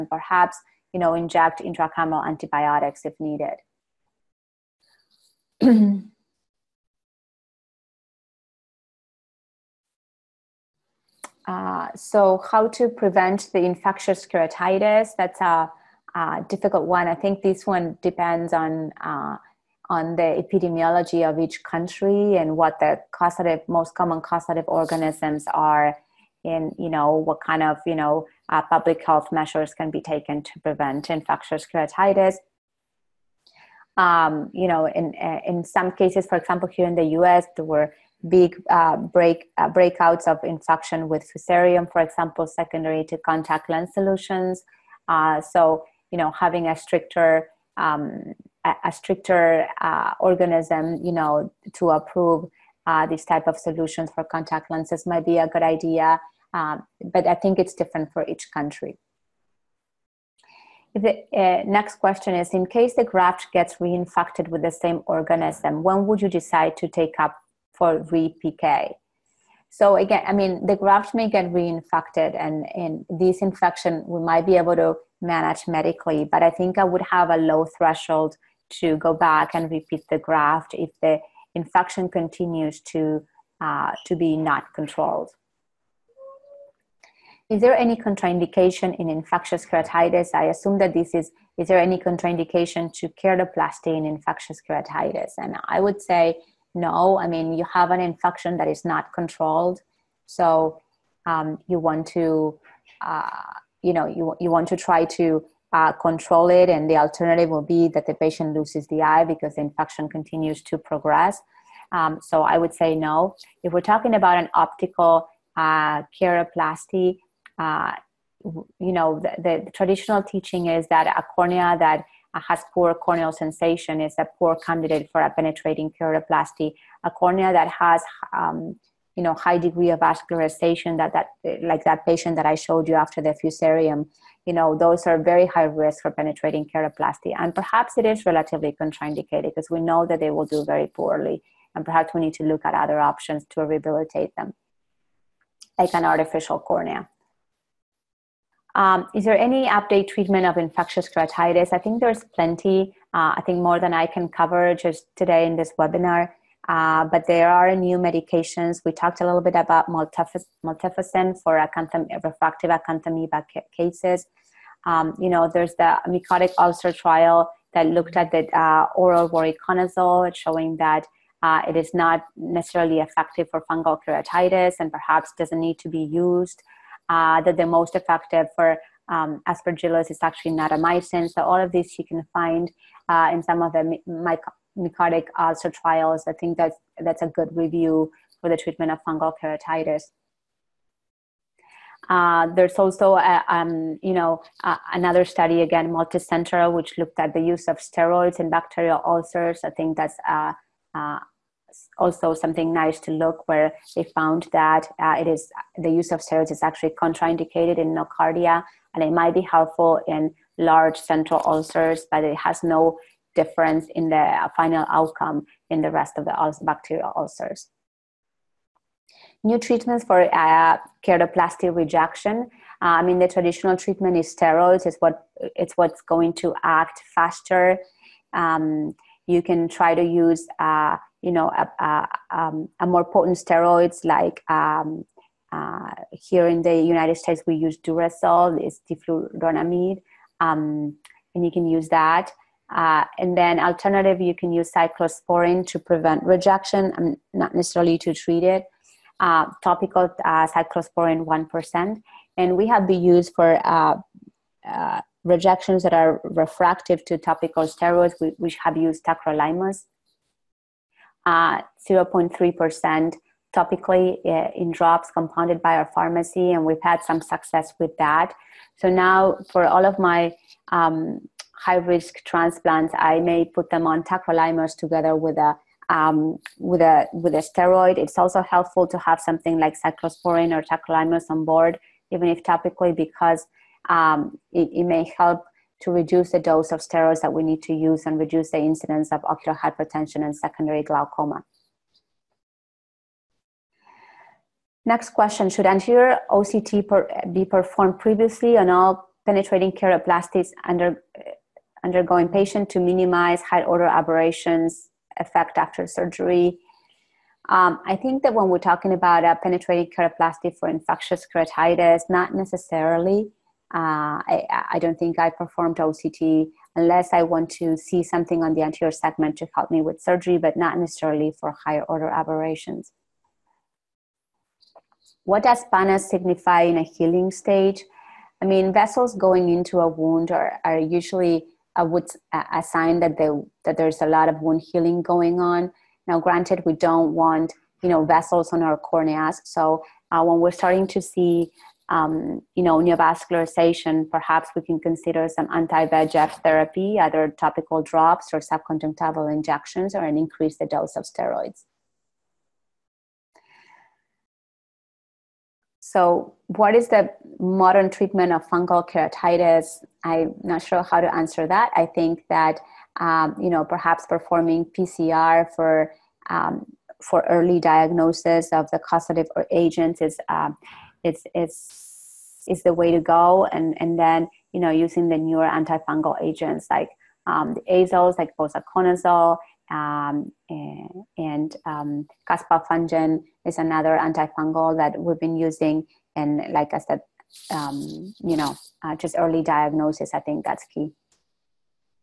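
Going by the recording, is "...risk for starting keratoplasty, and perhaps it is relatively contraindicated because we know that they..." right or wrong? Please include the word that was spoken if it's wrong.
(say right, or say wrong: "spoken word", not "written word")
wrong: "penetrating", not "starting".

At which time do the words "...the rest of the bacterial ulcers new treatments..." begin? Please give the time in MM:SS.
03:35.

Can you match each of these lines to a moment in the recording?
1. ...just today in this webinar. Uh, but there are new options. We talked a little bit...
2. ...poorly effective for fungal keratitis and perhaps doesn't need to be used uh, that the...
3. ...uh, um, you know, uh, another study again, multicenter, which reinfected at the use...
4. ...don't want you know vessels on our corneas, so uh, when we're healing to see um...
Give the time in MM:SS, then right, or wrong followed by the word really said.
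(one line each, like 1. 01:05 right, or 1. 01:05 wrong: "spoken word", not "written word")
1. 02:34 wrong: "medications", not "options"
2. 02:52 wrong: "necessarily", not "poorly"
3. 03:13 wrong: "looked", not "reinfected"
4. 05:36 wrong: "starting", not "healing".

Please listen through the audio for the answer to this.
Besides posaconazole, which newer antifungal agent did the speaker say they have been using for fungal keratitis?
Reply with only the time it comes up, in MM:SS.
06:22.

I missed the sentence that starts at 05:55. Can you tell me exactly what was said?
So, what is the modern treatment of fungal keratitis?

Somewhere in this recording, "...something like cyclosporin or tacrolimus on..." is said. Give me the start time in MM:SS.
04:39.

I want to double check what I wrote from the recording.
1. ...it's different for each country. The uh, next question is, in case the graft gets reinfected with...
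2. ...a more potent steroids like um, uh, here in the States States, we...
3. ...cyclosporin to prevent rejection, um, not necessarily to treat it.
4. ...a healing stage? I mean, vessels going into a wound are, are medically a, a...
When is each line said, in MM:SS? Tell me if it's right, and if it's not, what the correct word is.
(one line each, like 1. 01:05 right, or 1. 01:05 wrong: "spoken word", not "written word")
1. 00:57 right
2. 03:52 wrong: "United", not "States"
3. 04:04 right
4. 05:26 wrong: "usually", not "medically".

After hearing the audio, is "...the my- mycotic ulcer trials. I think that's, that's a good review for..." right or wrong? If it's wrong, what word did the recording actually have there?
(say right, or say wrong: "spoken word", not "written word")
right.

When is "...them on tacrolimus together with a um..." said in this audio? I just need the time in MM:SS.
04:33.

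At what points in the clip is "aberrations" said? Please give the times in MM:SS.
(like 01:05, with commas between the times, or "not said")
05:03, 05:22.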